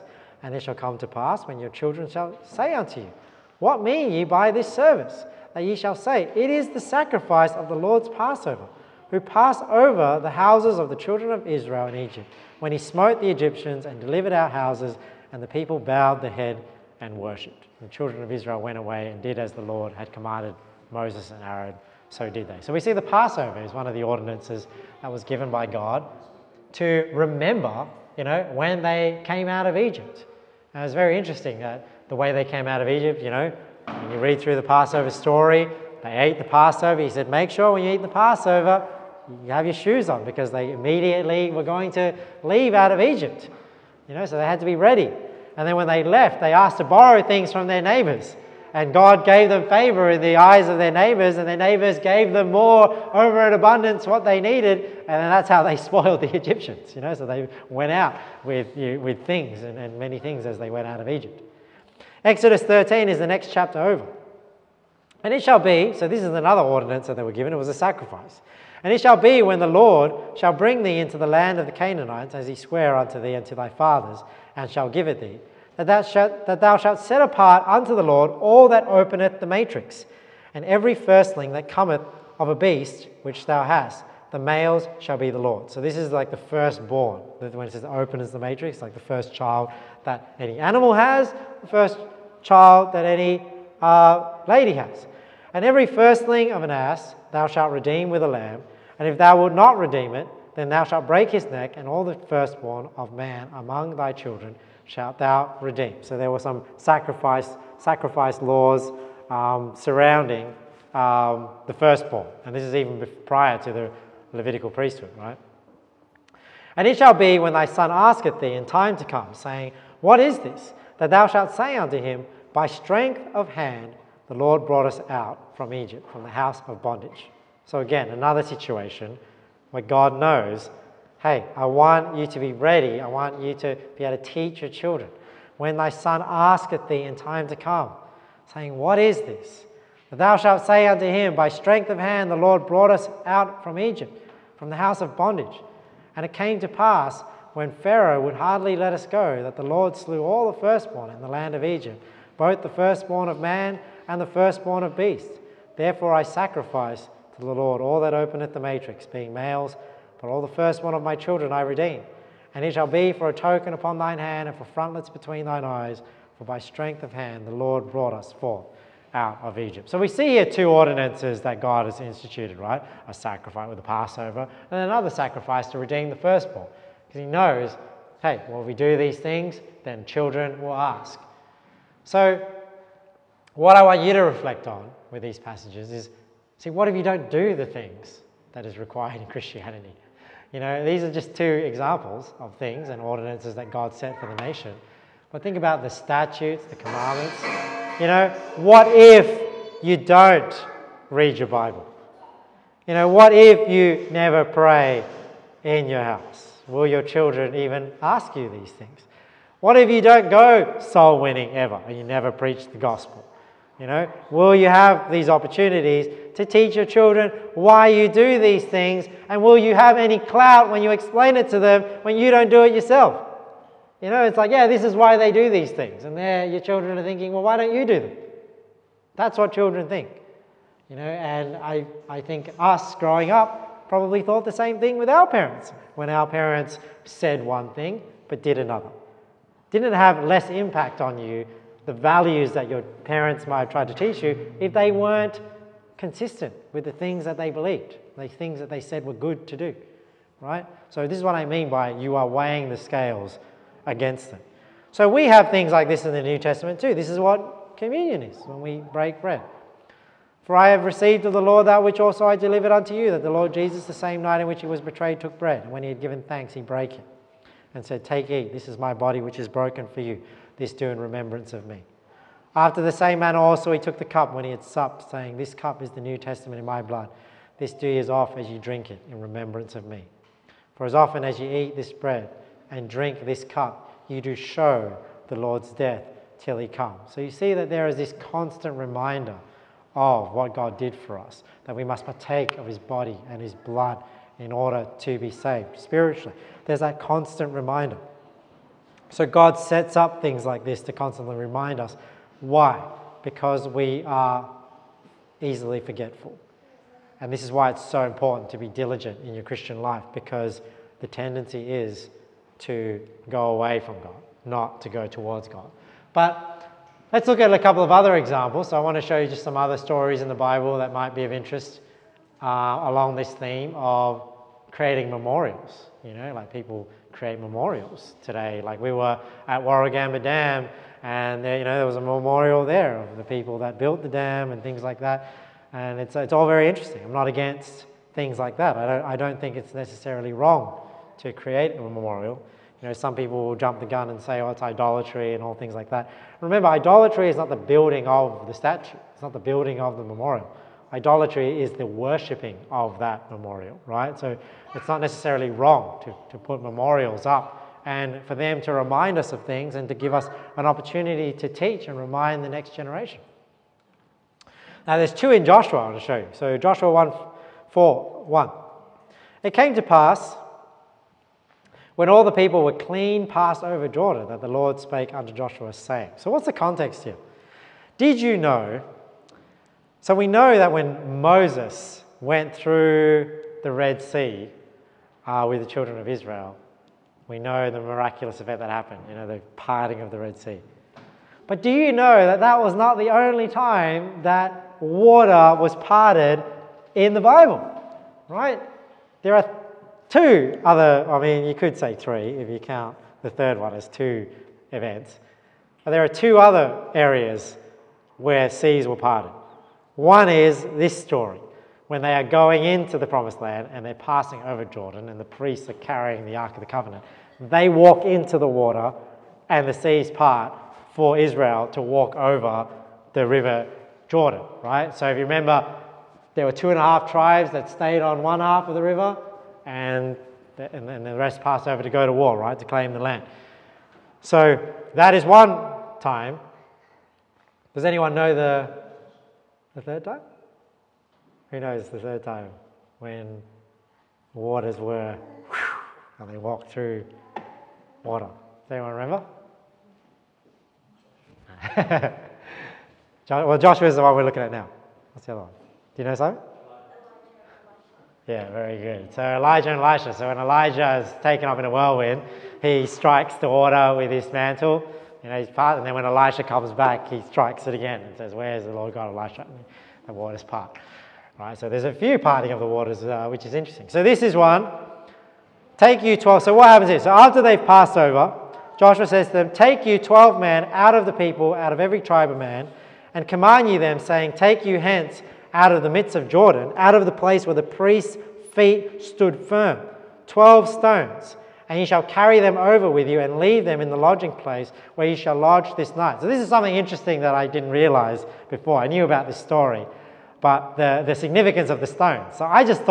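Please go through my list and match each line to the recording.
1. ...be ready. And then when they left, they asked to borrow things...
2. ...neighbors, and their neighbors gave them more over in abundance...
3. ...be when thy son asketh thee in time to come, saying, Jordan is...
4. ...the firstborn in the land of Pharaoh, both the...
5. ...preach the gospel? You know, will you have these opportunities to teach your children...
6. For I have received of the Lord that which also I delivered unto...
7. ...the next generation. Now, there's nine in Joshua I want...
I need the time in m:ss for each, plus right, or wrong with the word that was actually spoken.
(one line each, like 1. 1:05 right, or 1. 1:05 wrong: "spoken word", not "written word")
1. 0:44 right
2. 0:50 right
3. 1:57 wrong: "What", not "Jordan"
4. 2:30 wrong: "Egypt", not "Pharaoh"
5. 3:32 right
6. 4:20 right
7. 6:02 wrong: "two", not "nine".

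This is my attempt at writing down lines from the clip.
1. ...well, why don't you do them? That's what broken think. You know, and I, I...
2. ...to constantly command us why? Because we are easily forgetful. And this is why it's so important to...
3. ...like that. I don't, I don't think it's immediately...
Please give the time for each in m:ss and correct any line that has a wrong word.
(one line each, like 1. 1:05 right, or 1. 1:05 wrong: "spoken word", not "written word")
1. 3:47 wrong: "children", not "broken"
2. 5:00 wrong: "remind", not "command"
3. 5:38 wrong: "necessarily", not "immediately".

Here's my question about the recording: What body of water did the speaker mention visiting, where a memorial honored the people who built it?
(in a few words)
Warragamba Dam.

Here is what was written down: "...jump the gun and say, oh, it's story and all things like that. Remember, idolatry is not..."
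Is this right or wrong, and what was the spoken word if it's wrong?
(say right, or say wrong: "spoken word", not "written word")
wrong: "idolatry", not "story".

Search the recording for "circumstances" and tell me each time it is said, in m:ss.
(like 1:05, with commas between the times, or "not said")
not said.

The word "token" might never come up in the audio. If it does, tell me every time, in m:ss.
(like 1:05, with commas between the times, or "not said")
2:43.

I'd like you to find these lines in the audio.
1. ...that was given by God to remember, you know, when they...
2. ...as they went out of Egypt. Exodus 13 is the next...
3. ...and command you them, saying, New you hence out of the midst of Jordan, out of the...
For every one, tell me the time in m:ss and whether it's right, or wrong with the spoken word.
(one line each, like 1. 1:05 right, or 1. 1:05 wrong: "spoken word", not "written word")
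1. 0:25 right
2. 1:00 right
3. 8:03 wrong: "Take", not "New".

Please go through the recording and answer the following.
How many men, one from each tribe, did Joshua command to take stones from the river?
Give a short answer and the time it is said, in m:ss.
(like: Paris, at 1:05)
12, at 7:59.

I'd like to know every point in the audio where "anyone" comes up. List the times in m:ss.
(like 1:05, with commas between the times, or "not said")
7:17, 7:28.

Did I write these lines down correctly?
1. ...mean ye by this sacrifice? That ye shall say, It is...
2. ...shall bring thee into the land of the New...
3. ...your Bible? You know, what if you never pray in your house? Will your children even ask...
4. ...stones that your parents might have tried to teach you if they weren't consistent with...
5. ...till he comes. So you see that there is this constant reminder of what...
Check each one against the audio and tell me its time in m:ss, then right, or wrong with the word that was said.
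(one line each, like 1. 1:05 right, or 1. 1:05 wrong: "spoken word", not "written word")
1. 0:03 wrong: "service", not "sacrifice"
2. 1:10 wrong: "Canaanites", not "New"
3. 3:21 right
4. 4:01 wrong: "values", not "stones"
5. 4:46 right.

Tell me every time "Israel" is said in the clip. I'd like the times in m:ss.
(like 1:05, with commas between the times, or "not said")
0:11, 0:18, 6:26, 7:01.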